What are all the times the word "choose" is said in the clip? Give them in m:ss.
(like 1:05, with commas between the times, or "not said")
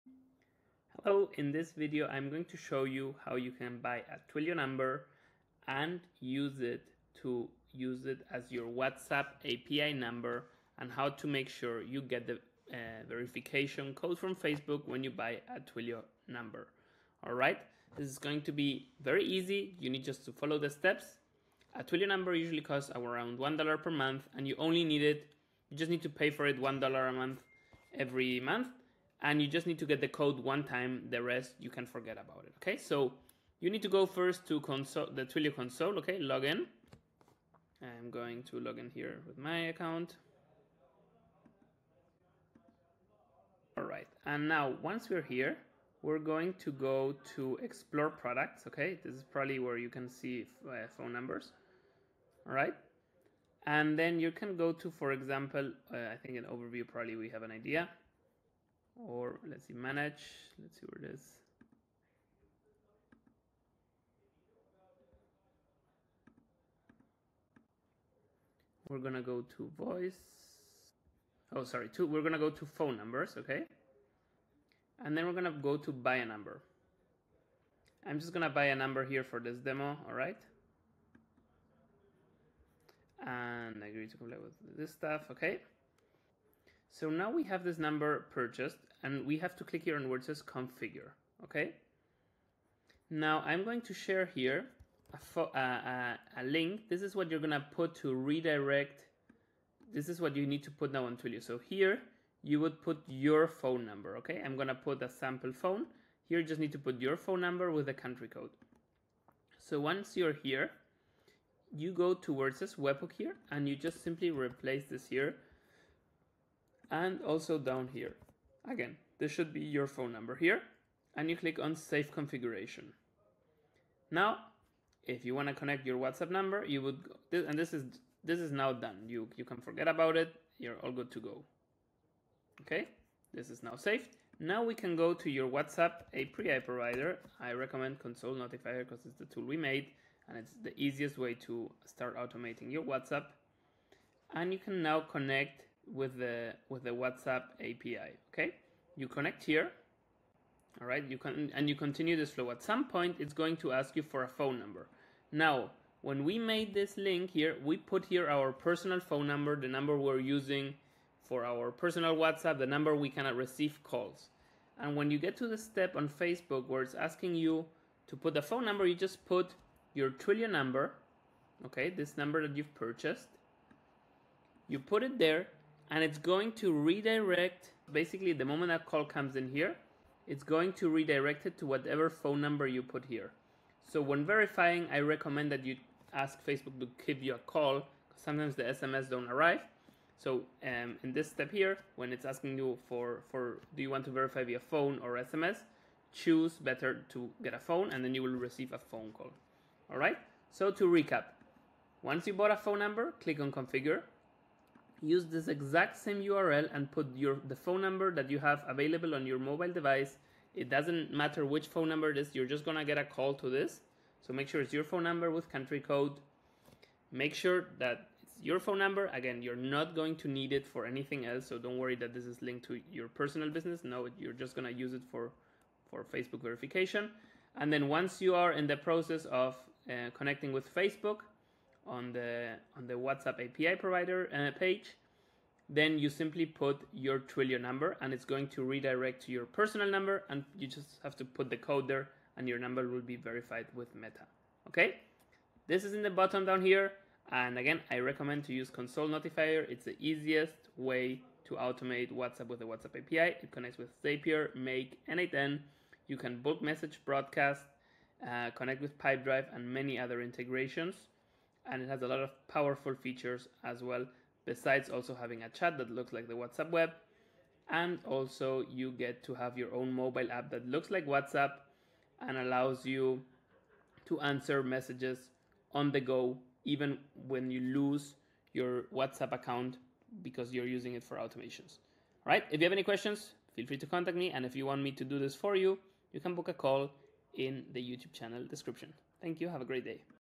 3:16.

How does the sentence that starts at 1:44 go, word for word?
I'm gonna put a sample phone.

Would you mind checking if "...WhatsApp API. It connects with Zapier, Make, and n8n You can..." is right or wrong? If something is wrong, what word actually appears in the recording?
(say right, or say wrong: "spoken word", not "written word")
right.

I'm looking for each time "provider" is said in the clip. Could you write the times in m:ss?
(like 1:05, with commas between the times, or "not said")
2:16, 3:53.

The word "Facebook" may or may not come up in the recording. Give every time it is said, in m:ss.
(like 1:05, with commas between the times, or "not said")
0:14, 2:46, 3:06, 3:46, 3:50.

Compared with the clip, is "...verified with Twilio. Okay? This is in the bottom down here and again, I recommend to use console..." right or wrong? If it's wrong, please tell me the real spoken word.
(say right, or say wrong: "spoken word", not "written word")
wrong: "Meta", not "Twilio".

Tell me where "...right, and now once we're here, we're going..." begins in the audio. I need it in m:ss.
0:43.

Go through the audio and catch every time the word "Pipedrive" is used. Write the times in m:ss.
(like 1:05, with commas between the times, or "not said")
4:18.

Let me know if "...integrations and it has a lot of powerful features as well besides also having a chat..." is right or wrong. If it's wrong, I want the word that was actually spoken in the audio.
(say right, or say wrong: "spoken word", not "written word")
right.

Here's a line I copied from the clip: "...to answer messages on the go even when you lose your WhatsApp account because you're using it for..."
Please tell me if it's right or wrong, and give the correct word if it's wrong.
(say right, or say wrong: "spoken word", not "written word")
right.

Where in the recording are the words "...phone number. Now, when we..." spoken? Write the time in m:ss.
2:34.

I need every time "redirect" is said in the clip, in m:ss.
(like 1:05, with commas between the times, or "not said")
1:38, 2:56, 3:00, 3:58.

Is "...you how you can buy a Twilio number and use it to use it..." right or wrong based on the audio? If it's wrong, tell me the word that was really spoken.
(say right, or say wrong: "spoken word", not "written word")
right.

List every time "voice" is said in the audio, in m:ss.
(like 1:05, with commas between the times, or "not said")
1:09.